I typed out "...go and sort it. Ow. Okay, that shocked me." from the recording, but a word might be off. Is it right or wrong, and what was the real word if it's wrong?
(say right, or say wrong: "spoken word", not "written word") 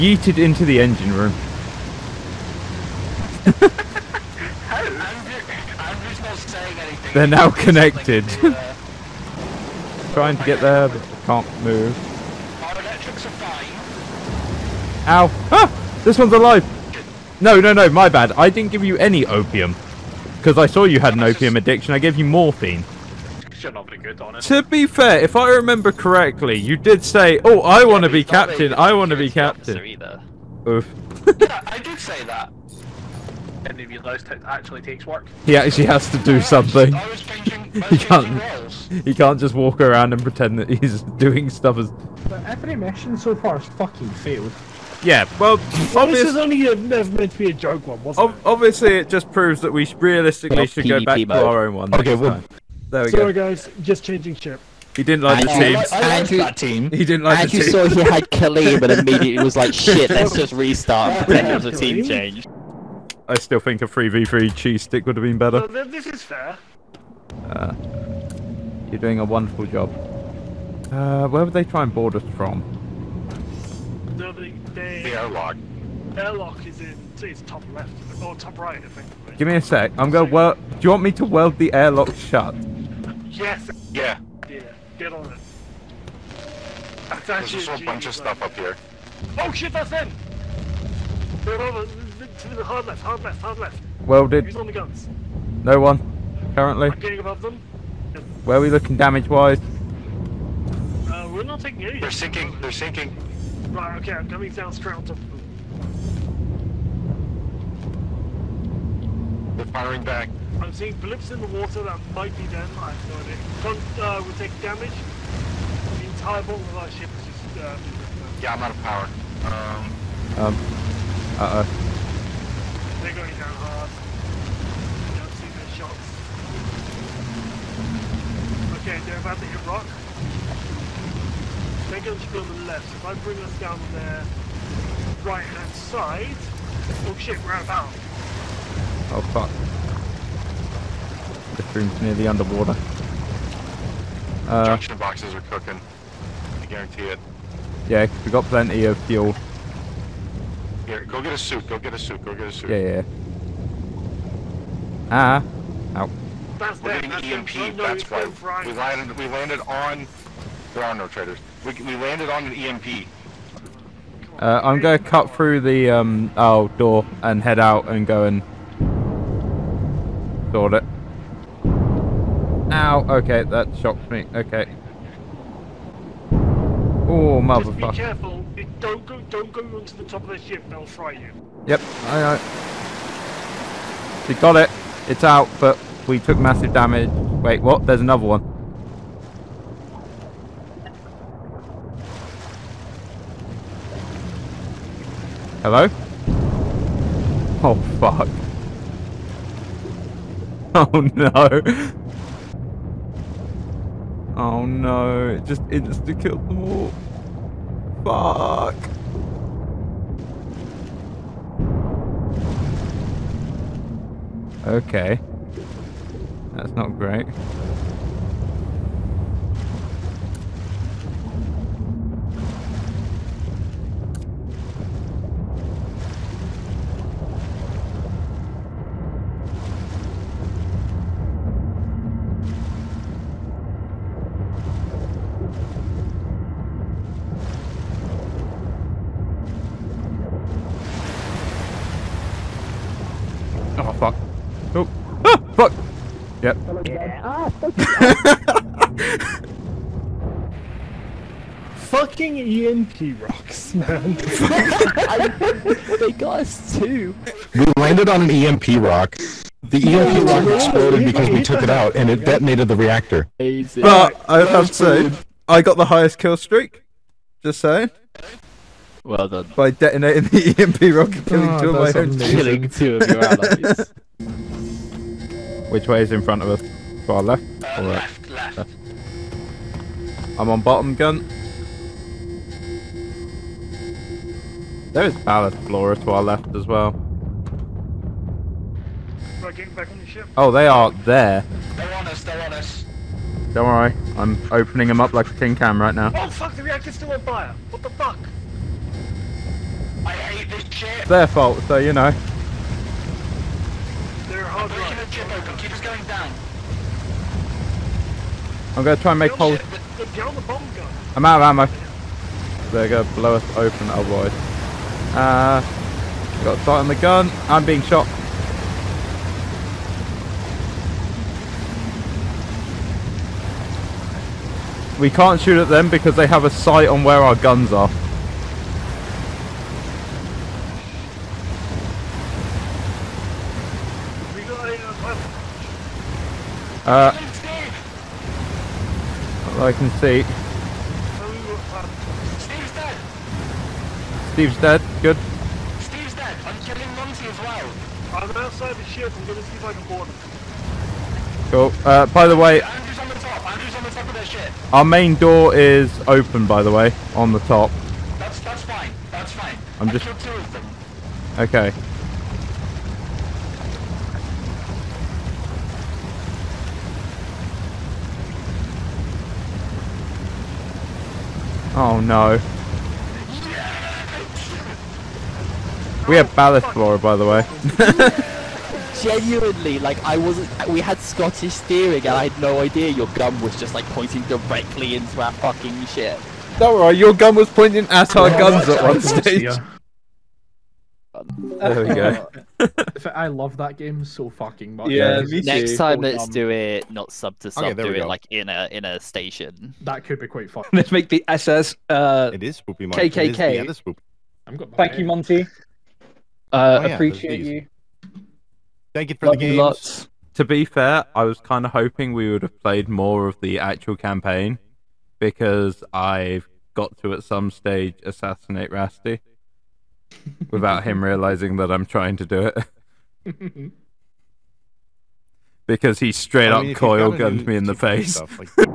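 right.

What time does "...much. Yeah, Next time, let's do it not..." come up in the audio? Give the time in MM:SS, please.
06:34.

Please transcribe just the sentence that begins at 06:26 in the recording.
Don't worry, your gun was pointing at our guns at one stage.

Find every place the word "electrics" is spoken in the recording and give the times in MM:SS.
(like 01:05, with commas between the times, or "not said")
00:12.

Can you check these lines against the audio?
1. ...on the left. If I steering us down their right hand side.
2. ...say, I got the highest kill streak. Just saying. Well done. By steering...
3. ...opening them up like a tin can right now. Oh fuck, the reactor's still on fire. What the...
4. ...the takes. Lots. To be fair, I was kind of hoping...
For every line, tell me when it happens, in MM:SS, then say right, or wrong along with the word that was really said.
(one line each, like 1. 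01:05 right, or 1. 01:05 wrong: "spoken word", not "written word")
1. 02:12 wrong: "bring", not "steering"
2. 04:24 wrong: "detonating", not "steering"
3. 04:54 right
4. 06:49 wrong: "games", not "takes".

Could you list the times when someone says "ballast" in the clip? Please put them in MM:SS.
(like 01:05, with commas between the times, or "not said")
04:45, 06:16.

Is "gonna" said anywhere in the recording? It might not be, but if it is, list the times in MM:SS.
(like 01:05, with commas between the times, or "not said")
01:20, 02:44, 05:08, 05:12.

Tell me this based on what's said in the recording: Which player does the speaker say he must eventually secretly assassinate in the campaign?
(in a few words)
Rasty.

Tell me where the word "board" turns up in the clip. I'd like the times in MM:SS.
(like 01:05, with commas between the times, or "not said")
01:11, 05:49.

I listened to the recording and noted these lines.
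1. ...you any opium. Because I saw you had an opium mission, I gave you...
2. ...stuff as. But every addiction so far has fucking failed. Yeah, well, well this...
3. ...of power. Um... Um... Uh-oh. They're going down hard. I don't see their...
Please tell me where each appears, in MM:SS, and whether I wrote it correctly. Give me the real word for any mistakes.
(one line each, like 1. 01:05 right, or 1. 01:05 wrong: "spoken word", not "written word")
1. 00:18 wrong: "addiction", not "mission"
2. 00:41 wrong: "mission", not "addiction"
3. 01:58 right.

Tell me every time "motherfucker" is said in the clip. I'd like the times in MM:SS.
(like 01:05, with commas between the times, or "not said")
02:57.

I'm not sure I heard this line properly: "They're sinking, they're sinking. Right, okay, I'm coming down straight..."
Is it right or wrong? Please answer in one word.
right.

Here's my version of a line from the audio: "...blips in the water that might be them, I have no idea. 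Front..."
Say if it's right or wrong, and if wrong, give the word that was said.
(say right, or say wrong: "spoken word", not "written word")
right.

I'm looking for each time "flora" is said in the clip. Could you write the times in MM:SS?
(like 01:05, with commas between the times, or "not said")
04:45, 06:16.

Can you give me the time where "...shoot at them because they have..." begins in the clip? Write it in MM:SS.
05:25.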